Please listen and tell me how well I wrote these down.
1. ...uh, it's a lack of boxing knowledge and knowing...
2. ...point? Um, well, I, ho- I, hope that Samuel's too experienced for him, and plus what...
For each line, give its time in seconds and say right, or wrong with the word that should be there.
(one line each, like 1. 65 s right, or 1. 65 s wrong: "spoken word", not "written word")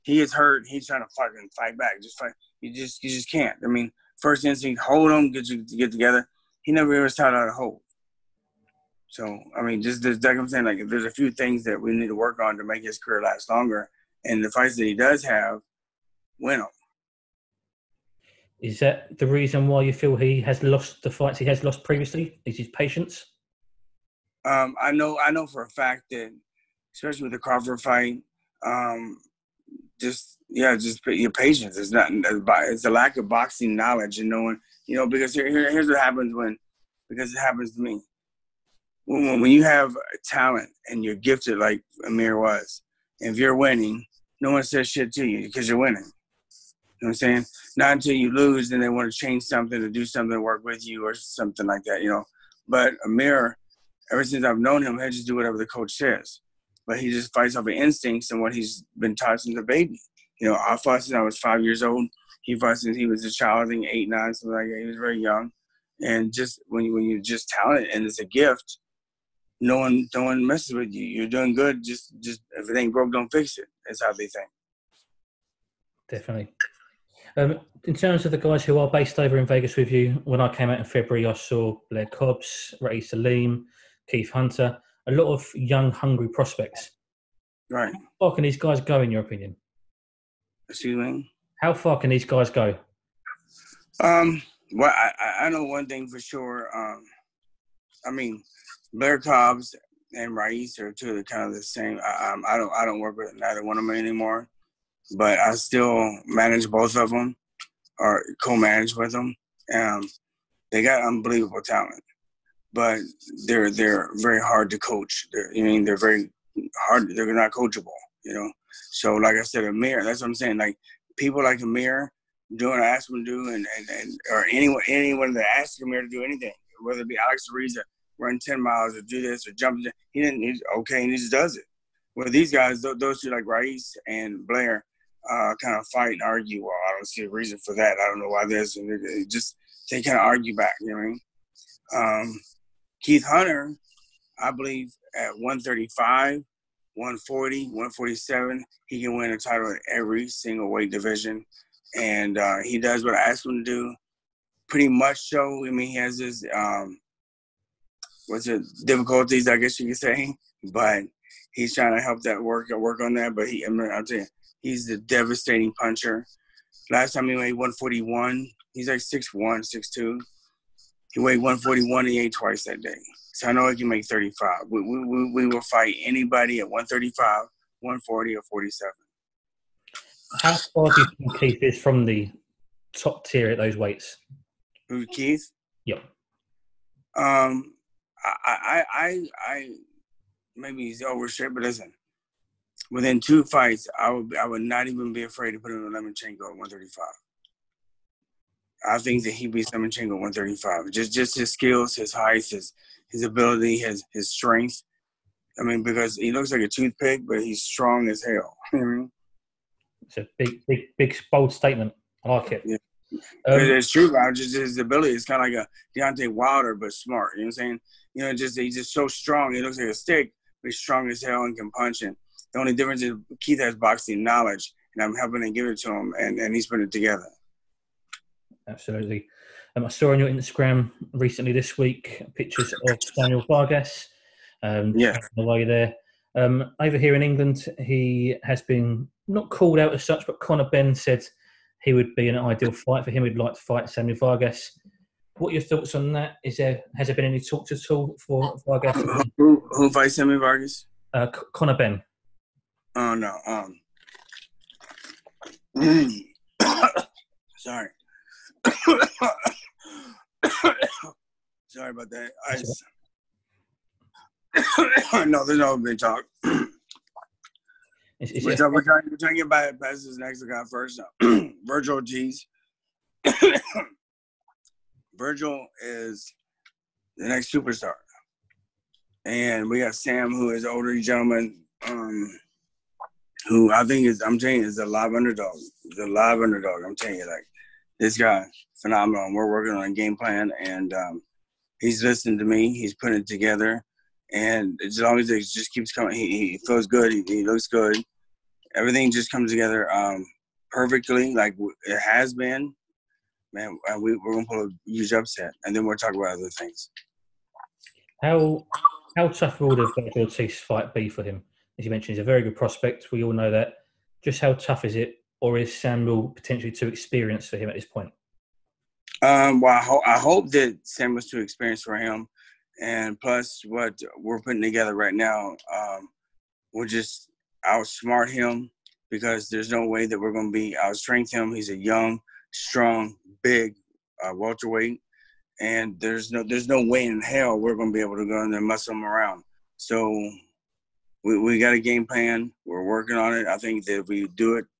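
1. 32 s right
2. 317 s right.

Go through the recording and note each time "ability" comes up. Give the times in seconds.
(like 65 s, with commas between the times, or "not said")
203 s, 214 s.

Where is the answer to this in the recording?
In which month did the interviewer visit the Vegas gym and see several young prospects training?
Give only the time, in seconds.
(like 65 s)
80 s.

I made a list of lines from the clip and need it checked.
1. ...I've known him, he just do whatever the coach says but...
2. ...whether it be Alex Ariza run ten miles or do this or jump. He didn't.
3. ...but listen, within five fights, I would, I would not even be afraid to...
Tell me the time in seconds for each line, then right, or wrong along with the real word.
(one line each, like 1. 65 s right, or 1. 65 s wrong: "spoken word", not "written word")
1. 54 s right
2. 126 s right
3. 191 s wrong: "two", not "five".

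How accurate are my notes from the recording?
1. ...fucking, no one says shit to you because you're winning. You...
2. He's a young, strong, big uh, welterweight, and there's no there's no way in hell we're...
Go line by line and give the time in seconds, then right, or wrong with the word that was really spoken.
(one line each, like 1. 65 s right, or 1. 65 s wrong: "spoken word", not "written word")
1. 43 s wrong: "winning", not "fucking"
2. 331 s right.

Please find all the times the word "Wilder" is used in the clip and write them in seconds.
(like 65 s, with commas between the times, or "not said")
216 s.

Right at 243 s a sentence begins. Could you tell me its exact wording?
He'd like to fight Samuel Vargas.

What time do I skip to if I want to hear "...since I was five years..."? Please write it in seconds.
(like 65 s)
61 s.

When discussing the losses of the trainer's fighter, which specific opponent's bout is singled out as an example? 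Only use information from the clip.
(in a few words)
Crawford.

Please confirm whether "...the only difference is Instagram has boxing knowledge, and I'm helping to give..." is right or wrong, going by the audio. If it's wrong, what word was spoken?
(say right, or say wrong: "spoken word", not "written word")
wrong: "Keith", not "Instagram".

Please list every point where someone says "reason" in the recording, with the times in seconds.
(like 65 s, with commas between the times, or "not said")
19 s, 137 s.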